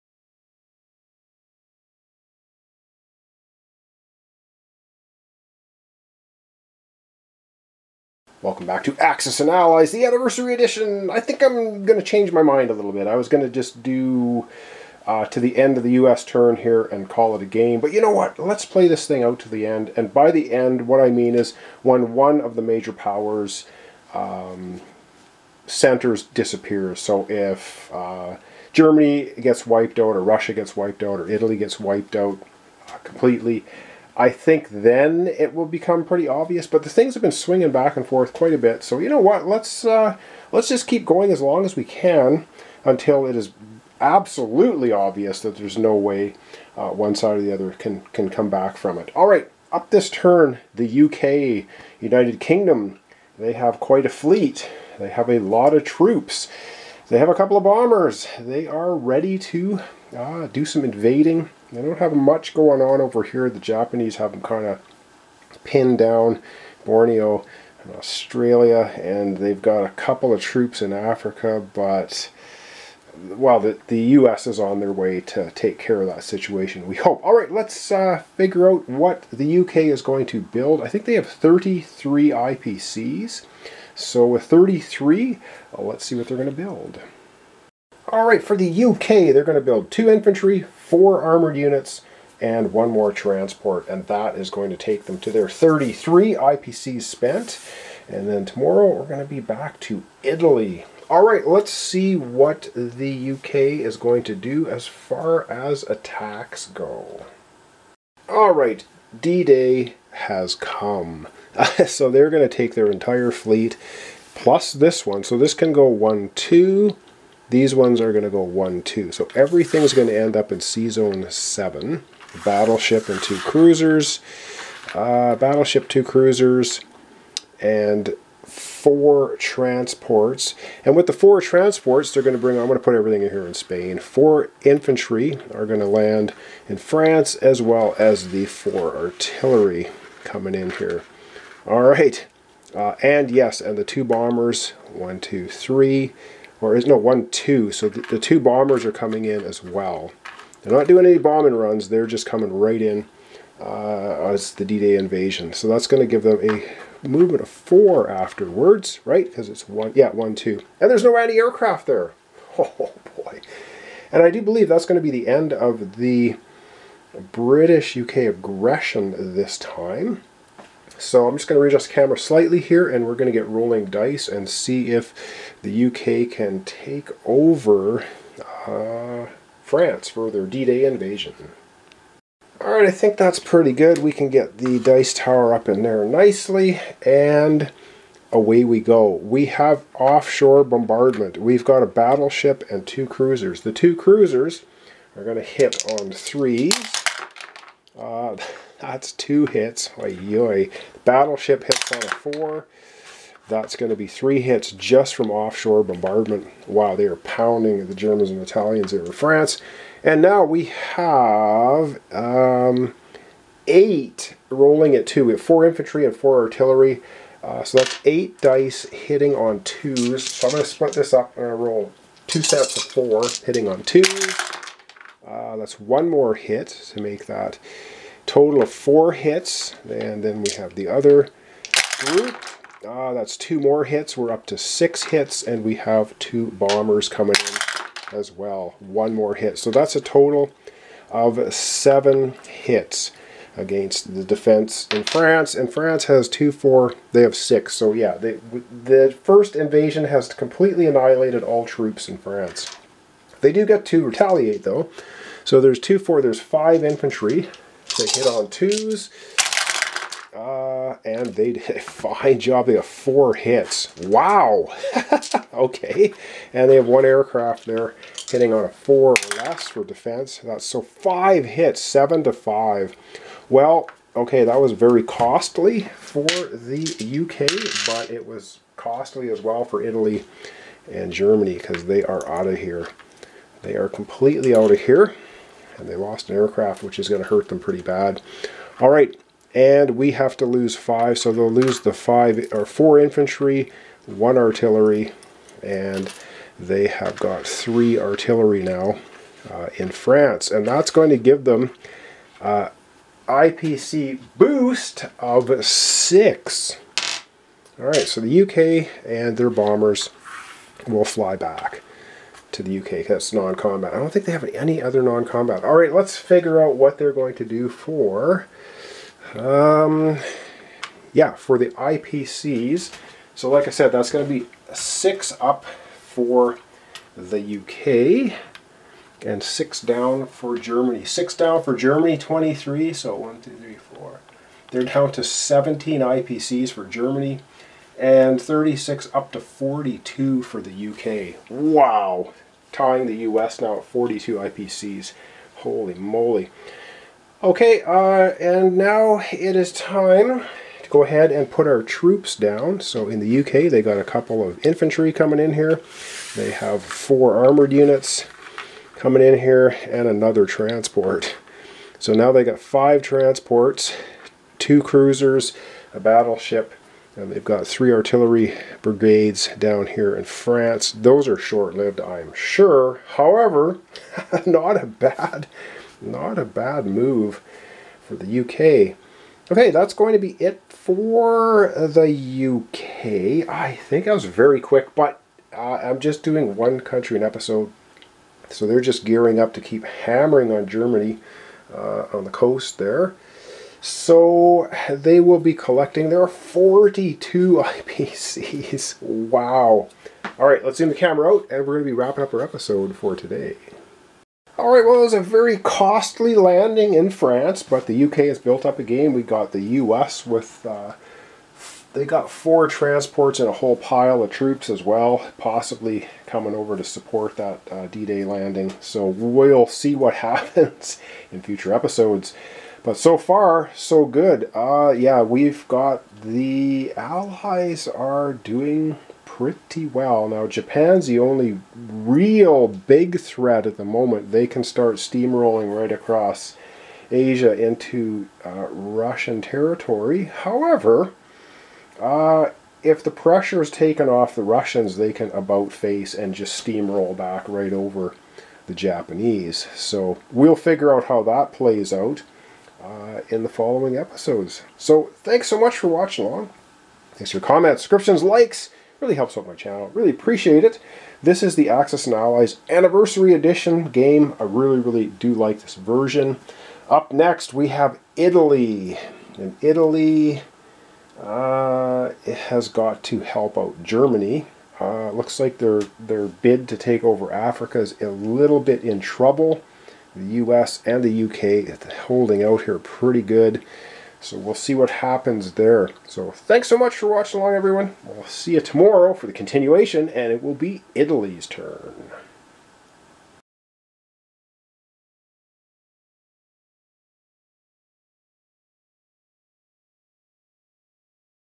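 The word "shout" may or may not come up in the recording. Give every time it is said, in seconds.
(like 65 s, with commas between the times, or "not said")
not said.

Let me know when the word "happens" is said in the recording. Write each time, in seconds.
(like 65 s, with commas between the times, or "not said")
420 s, 484 s.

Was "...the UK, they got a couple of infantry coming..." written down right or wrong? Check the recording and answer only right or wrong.
right.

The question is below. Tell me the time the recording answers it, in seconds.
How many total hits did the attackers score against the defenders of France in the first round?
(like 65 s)
239 s.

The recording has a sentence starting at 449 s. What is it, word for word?
So we'll figure out how that plays out uh, in the following episodes.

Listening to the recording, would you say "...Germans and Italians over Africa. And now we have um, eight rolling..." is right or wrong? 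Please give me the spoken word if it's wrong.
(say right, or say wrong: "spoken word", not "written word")
wrong: "France", not "Africa".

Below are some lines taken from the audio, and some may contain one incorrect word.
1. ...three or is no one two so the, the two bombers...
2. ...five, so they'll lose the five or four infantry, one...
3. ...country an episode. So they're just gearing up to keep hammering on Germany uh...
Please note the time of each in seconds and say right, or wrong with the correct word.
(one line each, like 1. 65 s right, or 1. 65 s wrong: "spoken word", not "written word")
1. 145 s right
2. 290 s right
3. 386 s right.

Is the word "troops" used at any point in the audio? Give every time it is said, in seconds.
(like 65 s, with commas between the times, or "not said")
55 s, 70 s, 251 s, 351 s, 414 s.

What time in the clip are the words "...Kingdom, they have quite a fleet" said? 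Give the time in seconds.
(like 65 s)
52 s.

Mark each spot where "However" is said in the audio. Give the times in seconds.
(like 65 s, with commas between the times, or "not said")
373 s, 440 s.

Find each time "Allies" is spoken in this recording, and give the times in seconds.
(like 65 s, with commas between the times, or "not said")
9 s, 426 s, 462 s.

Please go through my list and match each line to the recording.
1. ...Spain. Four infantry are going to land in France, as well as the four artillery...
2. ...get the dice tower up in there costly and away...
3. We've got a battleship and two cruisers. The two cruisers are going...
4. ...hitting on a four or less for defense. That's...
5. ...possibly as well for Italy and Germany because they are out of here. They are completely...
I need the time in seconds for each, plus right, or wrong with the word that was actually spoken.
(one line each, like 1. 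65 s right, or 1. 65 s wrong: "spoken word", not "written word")
1. 133 s right
2. 184 s wrong: "nicely", not "costly"
3. 191 s right
4. 268 s right
5. 278 s wrong: "costly", not "possibly".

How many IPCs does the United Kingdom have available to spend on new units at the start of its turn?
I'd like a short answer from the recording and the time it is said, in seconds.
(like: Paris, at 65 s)
33, at 80 s.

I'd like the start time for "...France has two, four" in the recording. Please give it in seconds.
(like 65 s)
245 s.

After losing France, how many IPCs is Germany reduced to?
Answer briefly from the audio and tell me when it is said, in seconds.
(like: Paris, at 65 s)
17, at 334 s.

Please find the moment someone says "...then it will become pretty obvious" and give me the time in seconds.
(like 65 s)
34 s.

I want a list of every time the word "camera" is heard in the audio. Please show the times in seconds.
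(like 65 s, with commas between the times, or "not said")
171 s, 400 s.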